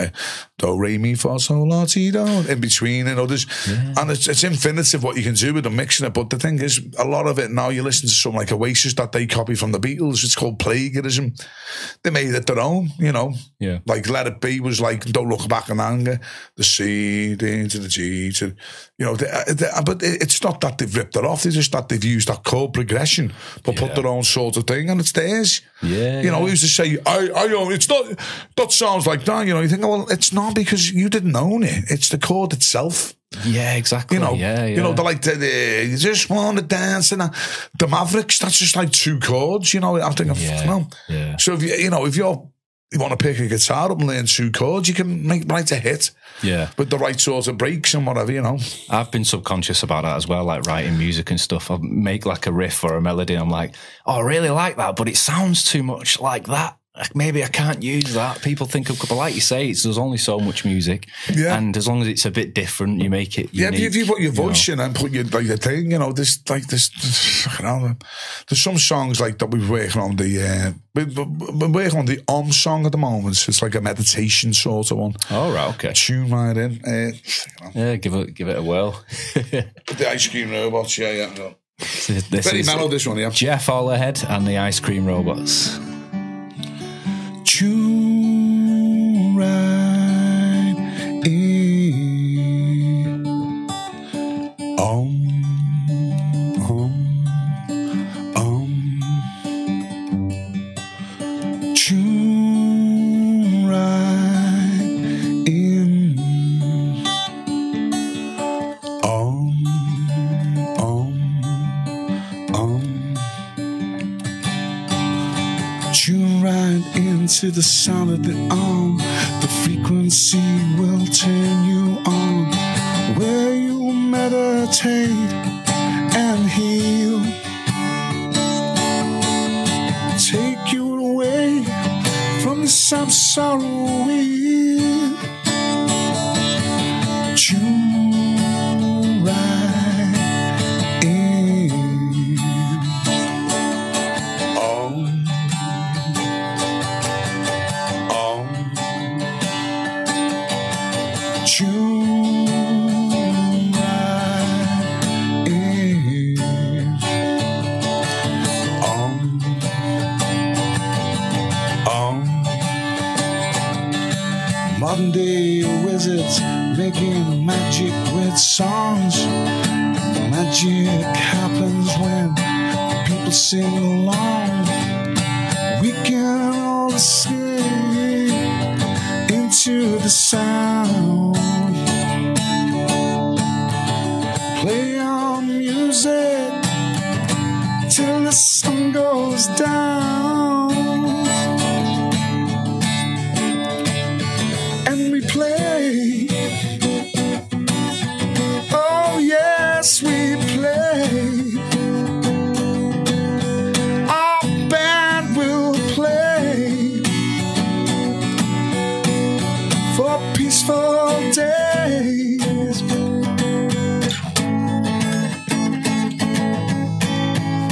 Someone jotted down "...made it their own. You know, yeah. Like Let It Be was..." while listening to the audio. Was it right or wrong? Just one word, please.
right.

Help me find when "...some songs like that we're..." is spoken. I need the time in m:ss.
1:08.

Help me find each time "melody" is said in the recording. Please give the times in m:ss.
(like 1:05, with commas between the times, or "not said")
0:53.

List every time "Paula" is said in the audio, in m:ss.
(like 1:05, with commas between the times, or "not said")
not said.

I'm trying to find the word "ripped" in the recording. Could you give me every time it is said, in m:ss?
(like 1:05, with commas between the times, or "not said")
0:20.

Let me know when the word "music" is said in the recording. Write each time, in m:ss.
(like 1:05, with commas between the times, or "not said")
0:50, 1:00.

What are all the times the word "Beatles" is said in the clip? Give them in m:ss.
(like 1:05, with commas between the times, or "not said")
0:09.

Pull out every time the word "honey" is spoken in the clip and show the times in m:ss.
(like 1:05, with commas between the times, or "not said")
not said.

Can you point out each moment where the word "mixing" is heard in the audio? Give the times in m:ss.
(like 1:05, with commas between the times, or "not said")
0:05.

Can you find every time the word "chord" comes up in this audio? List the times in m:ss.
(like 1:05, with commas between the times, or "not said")
0:22, 0:32, 0:39, 0:44.